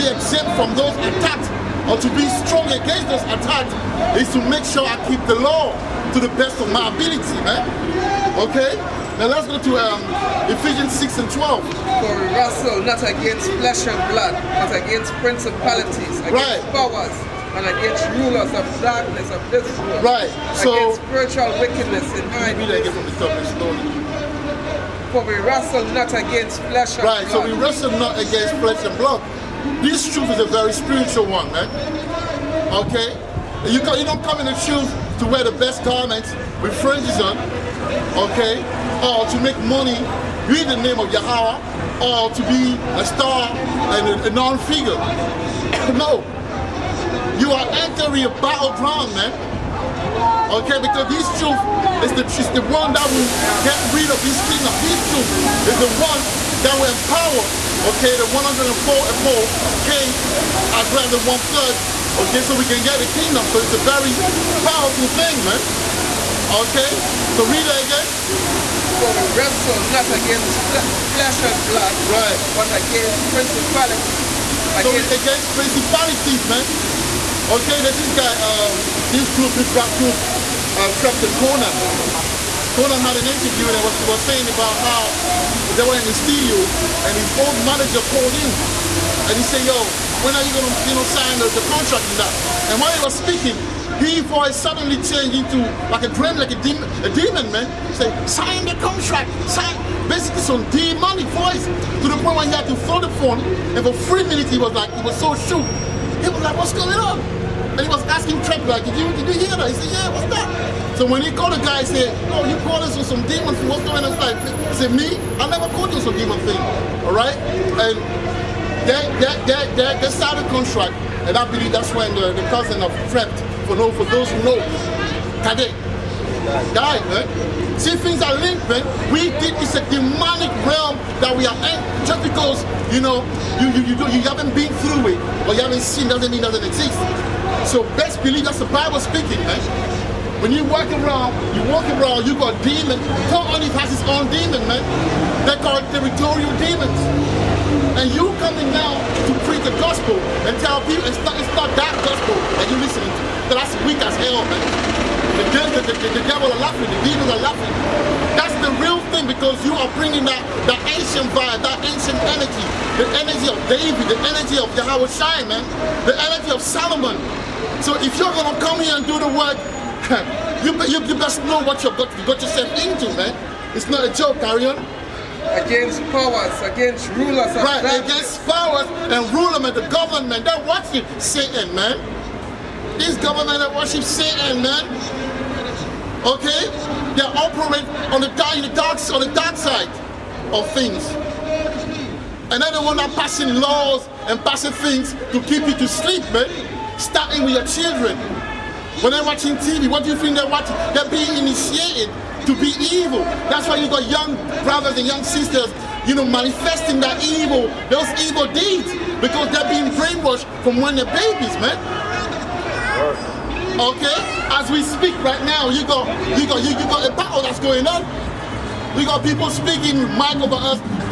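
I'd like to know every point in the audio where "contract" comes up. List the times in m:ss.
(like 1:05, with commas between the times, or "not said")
1:31, 1:38, 2:00.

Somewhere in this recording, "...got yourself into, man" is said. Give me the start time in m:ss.
2:52.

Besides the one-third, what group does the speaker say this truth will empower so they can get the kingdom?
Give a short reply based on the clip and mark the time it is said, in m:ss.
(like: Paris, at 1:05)
104K, at 0:58.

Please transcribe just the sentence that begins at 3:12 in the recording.
And then the one that passing laws and passing things to keep you to sleep, man.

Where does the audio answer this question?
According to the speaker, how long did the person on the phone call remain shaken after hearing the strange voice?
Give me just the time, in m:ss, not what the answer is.
1:44.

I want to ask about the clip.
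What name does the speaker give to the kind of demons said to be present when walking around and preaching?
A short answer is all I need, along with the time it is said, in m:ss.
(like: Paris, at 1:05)
Territorial demons, at 2:25.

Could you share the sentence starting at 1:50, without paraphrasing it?
So when he called the guy, he said, oh, you called us with some demon thing, what's going on?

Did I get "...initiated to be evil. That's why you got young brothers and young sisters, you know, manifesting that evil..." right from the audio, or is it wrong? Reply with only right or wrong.
right.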